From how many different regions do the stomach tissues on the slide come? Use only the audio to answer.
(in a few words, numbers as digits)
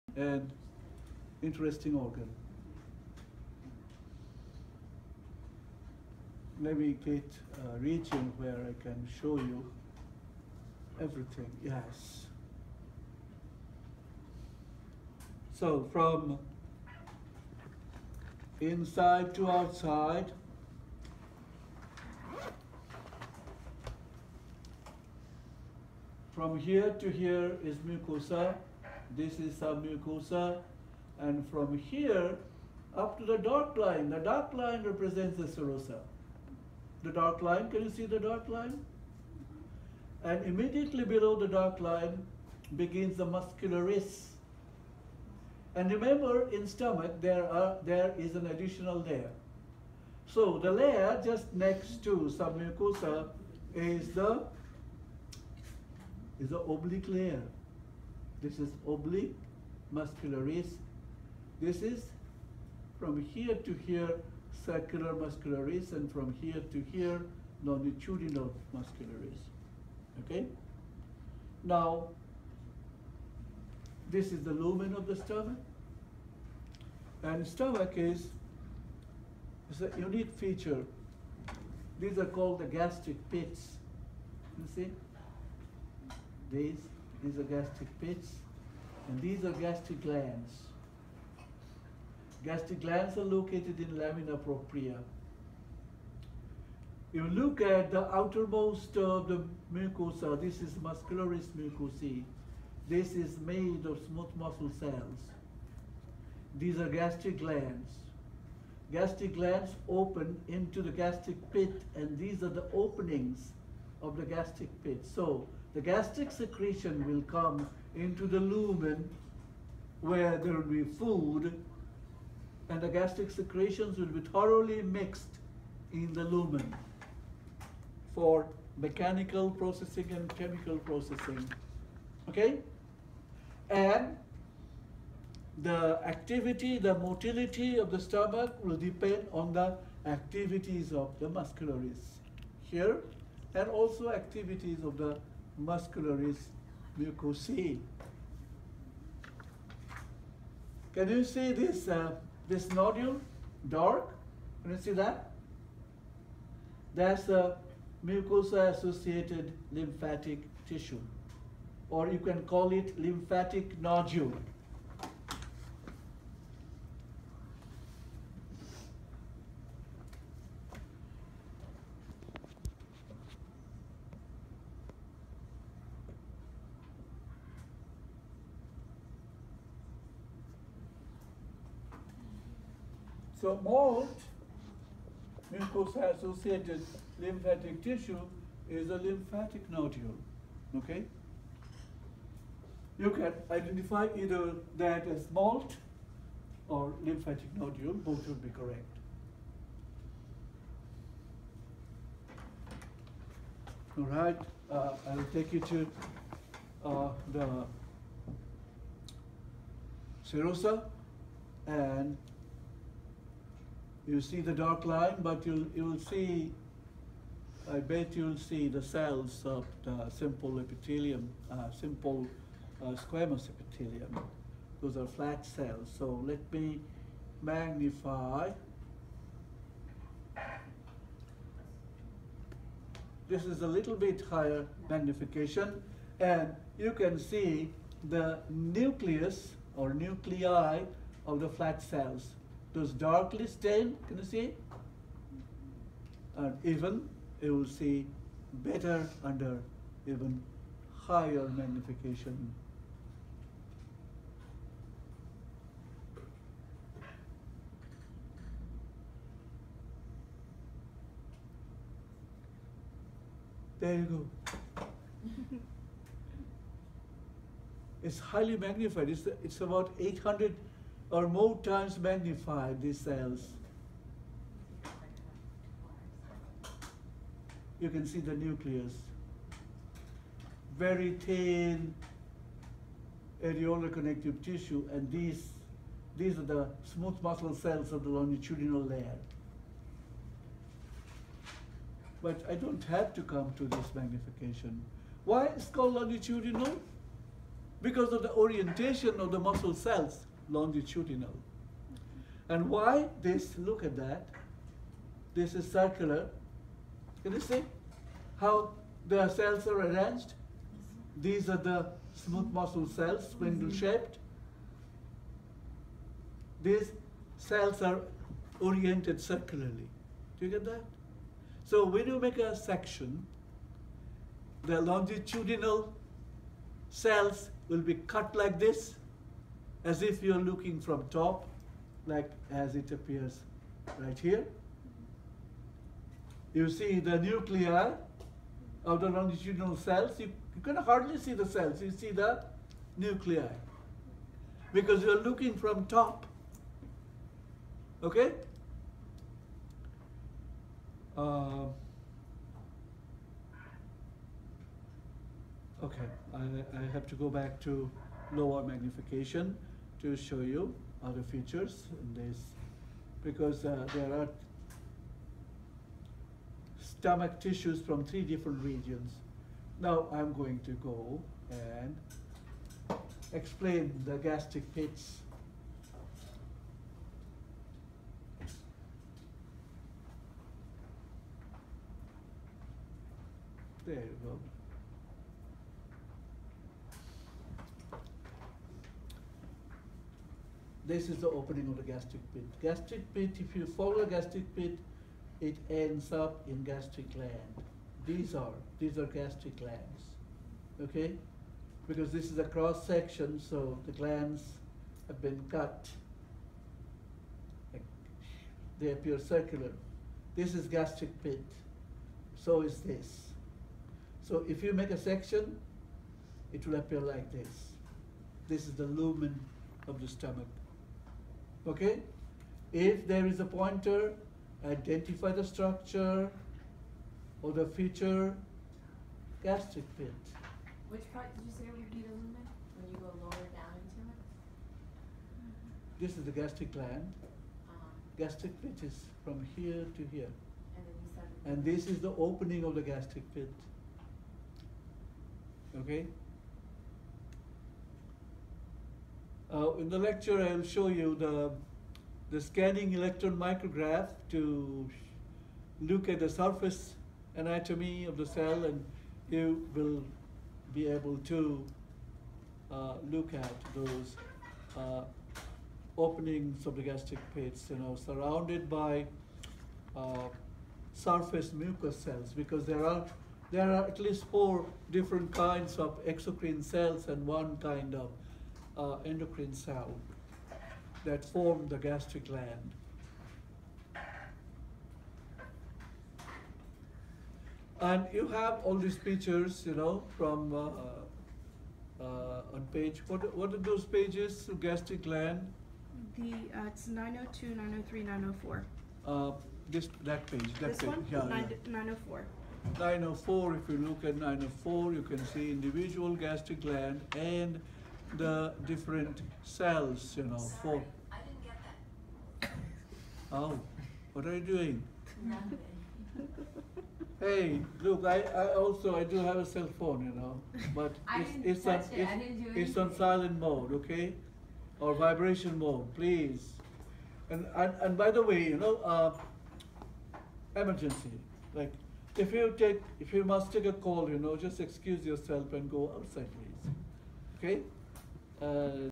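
3.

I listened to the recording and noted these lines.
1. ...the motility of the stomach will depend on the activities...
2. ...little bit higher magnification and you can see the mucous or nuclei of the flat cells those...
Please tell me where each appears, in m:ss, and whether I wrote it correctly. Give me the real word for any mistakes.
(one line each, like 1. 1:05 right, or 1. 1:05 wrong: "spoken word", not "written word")
1. 2:16 right
2. 3:53 wrong: "nucleus", not "mucous".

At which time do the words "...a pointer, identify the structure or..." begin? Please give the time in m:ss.
7:03.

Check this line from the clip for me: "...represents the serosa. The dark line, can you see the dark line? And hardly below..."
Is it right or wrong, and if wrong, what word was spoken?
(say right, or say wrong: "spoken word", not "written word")
wrong: "immediately", not "hardly".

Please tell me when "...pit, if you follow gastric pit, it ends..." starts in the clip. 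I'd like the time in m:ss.
6:33.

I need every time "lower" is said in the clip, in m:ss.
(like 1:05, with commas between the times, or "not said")
5:58, 7:13.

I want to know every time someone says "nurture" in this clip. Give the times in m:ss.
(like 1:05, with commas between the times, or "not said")
not said.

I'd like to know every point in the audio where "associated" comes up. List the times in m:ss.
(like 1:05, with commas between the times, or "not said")
2:38, 3:05.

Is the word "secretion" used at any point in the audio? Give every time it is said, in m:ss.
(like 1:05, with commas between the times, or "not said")
1:56, 2:03.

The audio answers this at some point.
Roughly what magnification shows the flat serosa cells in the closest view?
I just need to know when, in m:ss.
4:29.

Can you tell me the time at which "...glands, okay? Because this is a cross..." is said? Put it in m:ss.
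6:39.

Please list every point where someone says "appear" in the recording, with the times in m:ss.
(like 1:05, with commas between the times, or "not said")
5:32, 6:48, 6:56.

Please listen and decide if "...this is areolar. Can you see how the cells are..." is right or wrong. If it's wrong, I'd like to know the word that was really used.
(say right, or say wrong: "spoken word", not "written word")
wrong: "circular", not "areolar".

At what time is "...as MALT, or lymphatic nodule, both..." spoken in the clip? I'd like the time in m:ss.
3:15.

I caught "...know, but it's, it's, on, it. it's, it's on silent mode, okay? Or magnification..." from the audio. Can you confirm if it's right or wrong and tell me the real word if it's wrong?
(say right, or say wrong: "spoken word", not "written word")
wrong: "vibration", not "magnification".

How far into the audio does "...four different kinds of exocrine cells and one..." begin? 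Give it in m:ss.
7:54.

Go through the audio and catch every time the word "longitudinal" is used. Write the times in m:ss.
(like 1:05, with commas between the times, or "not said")
1:07, 4:48, 4:55, 5:00, 5:24, 5:39.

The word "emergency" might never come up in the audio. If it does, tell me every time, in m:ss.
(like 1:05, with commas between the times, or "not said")
8:50.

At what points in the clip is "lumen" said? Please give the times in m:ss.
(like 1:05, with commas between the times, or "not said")
1:14, 1:58, 2:06, 6:58, 7:12.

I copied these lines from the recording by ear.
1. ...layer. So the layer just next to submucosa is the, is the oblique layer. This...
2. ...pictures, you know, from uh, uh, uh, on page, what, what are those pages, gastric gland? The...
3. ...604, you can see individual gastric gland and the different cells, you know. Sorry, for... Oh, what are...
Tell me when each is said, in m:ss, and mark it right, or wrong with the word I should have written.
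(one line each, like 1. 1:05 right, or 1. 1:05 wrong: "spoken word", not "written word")
1. 0:48 right
2. 8:08 right
3. 8:24 wrong: "904", not "604".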